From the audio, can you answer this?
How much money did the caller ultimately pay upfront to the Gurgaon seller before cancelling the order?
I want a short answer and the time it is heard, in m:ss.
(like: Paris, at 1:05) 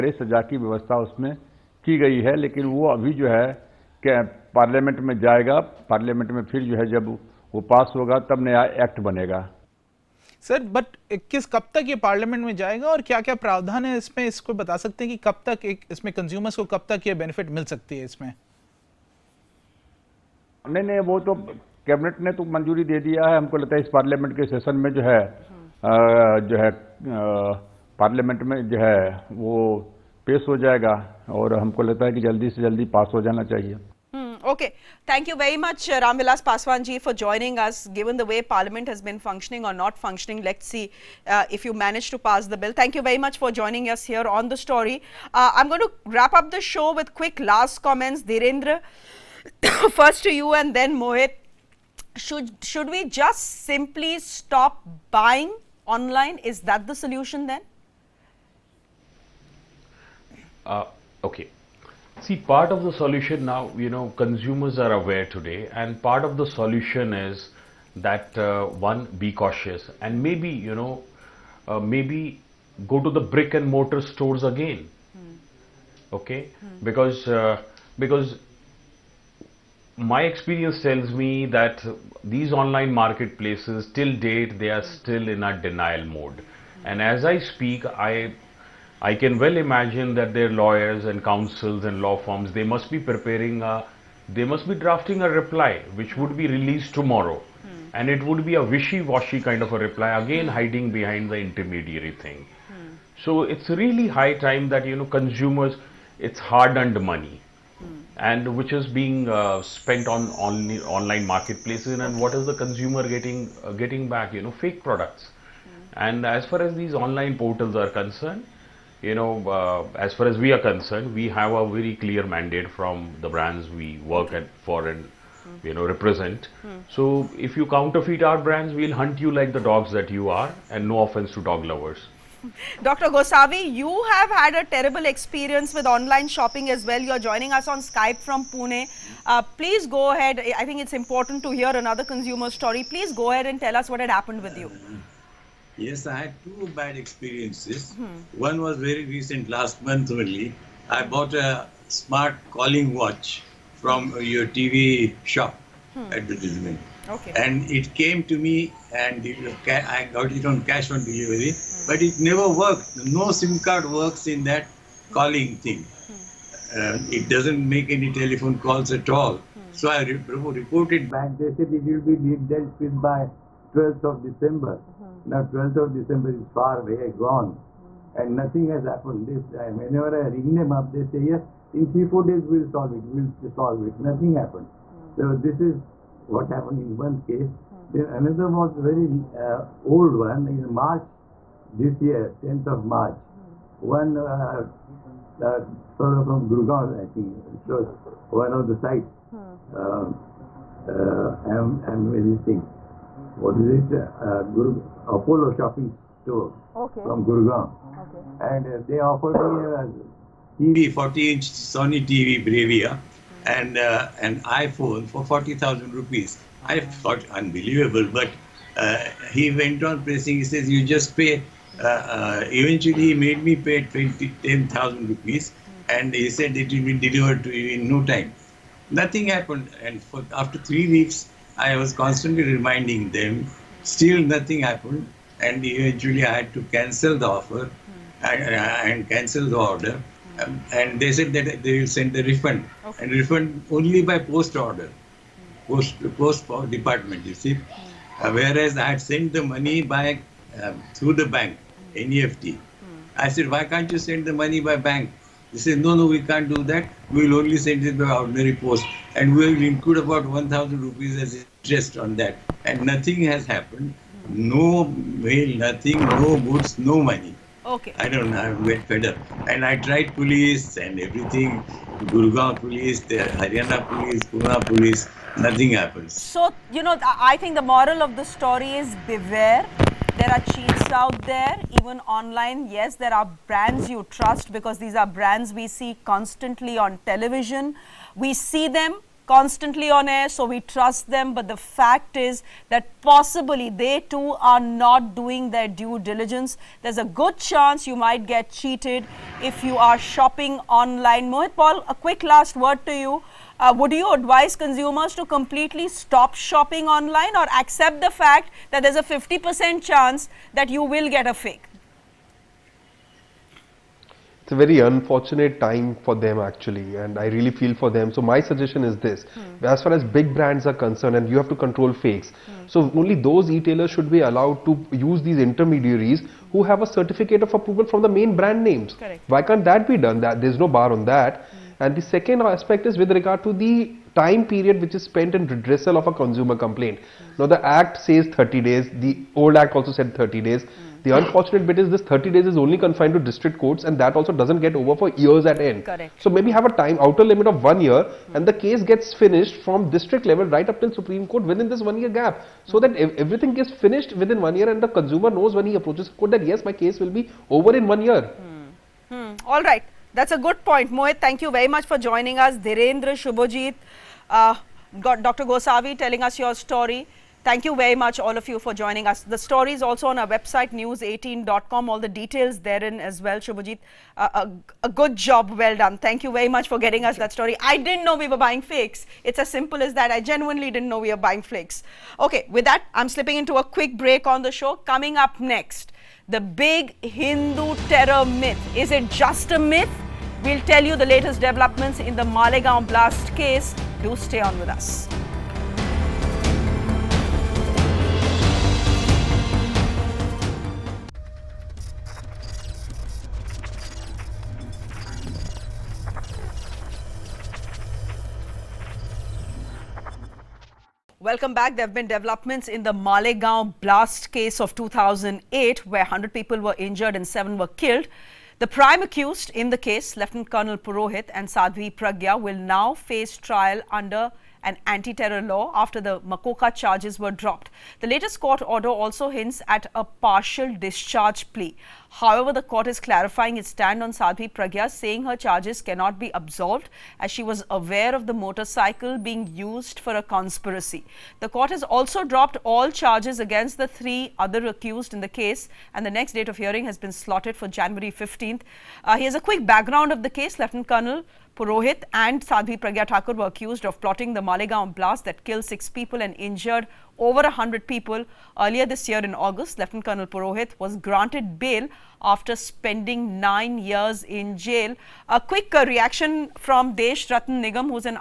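10,000 rupees, at 3:44.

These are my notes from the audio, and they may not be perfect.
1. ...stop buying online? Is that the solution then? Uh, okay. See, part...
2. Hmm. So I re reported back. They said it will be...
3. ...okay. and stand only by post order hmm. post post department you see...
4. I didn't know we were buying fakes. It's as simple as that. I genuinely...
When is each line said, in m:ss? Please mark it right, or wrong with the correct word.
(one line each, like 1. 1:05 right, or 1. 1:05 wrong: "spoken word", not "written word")
1. 0:54 right
2. 2:49 right
3. 4:02 wrong: "refund", not "stand"
4. 6:17 right.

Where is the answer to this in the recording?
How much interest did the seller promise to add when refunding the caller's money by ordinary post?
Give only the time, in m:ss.
4:20.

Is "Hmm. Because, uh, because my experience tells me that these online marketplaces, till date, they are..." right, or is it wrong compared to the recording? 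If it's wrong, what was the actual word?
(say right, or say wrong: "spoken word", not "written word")
right.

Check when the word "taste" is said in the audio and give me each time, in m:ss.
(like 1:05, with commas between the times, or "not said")
not said.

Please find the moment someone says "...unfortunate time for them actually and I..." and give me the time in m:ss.
5:14.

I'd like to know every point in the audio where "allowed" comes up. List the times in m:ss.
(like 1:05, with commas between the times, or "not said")
5:24.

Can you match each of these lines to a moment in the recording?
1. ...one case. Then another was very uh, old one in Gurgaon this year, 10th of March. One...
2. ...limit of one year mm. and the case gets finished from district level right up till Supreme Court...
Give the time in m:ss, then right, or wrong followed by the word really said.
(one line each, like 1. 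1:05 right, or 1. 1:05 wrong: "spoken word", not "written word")
1. 3:06 wrong: "March", not "Gurgaon"
2. 5:47 right.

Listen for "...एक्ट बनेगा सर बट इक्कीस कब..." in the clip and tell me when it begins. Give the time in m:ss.
0:08.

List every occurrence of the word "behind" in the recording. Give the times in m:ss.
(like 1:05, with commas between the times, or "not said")
1:40.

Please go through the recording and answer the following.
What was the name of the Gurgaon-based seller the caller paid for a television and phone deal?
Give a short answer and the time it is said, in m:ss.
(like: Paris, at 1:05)
Apollo shopping store, at 3:25.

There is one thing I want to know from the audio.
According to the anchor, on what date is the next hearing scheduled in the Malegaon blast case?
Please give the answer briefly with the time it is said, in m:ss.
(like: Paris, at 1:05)
January 15th, at 7:27.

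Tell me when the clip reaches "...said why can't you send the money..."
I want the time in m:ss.
4:13.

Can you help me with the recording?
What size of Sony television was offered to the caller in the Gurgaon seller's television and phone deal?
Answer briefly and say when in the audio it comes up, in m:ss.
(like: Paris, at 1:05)
40-inch, at 3:30.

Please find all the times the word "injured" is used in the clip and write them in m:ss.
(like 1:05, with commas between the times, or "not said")
6:56, 7:36.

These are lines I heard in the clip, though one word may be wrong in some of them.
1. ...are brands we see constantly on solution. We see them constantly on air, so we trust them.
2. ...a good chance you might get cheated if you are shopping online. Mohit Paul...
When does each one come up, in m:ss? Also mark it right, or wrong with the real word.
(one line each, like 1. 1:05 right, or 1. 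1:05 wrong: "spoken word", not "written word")
1. 4:44 wrong: "television", not "solution"
2. 4:56 right.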